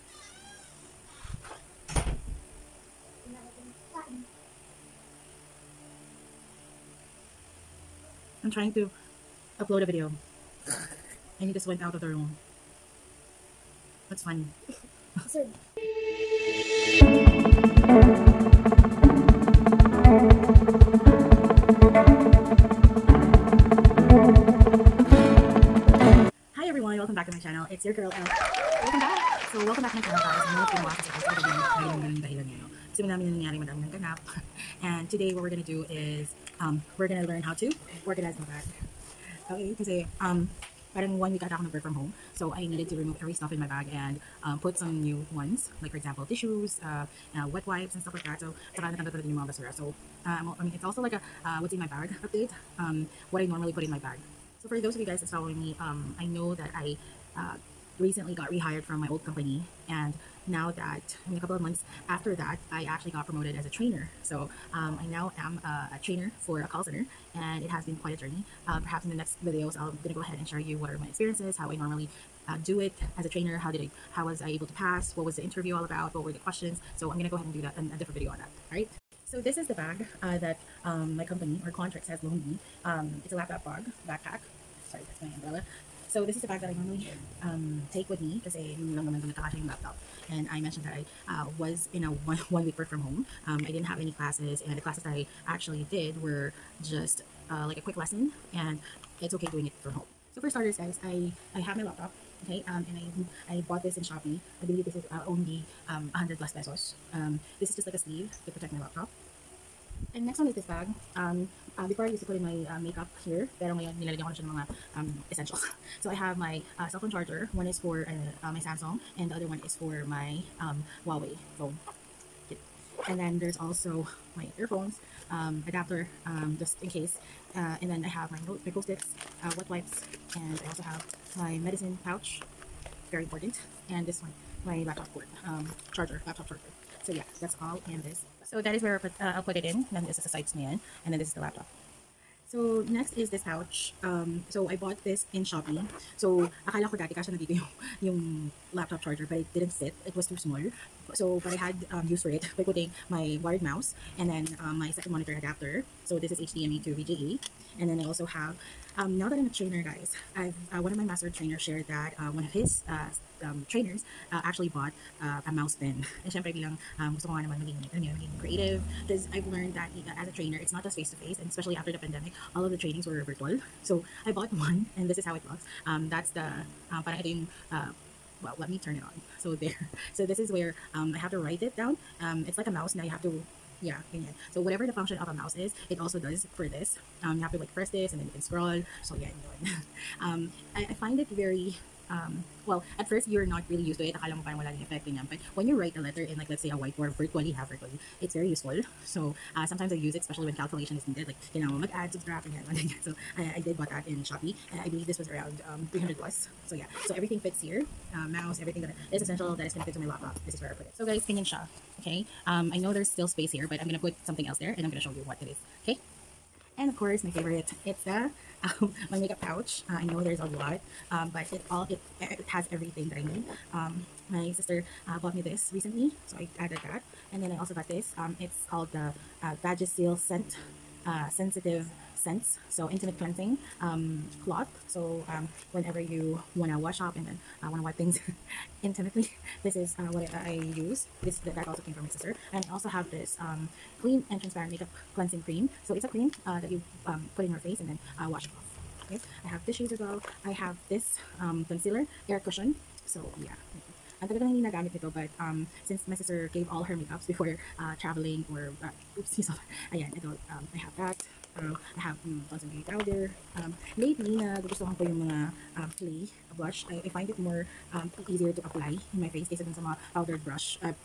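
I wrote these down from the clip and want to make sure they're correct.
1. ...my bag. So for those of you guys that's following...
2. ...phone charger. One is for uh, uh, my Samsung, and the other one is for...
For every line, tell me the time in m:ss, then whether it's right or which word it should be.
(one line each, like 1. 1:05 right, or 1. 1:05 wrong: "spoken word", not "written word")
1. 0:53 right
2. 1:56 right.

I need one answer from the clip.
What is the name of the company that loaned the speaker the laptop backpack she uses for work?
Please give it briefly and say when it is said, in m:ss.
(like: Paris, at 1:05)
Quantrix, at 1:21.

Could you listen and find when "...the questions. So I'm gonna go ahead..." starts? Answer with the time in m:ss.
1:16.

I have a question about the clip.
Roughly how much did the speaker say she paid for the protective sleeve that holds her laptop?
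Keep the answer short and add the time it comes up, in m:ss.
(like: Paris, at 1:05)
100 plus pesos, at 1:46.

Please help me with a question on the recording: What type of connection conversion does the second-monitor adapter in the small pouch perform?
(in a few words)
HDMI to VGA.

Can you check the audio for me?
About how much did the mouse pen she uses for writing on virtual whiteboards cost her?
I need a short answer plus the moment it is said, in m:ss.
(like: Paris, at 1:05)
300 plus, at 3:25.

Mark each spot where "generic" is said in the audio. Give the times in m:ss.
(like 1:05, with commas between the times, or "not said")
not said.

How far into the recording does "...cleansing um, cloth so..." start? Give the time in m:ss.
3:53.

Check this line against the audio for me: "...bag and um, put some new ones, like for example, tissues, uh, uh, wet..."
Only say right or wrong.
right.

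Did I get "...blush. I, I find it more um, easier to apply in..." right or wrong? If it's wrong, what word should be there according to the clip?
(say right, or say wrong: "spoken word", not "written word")
right.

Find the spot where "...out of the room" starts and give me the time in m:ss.
0:11.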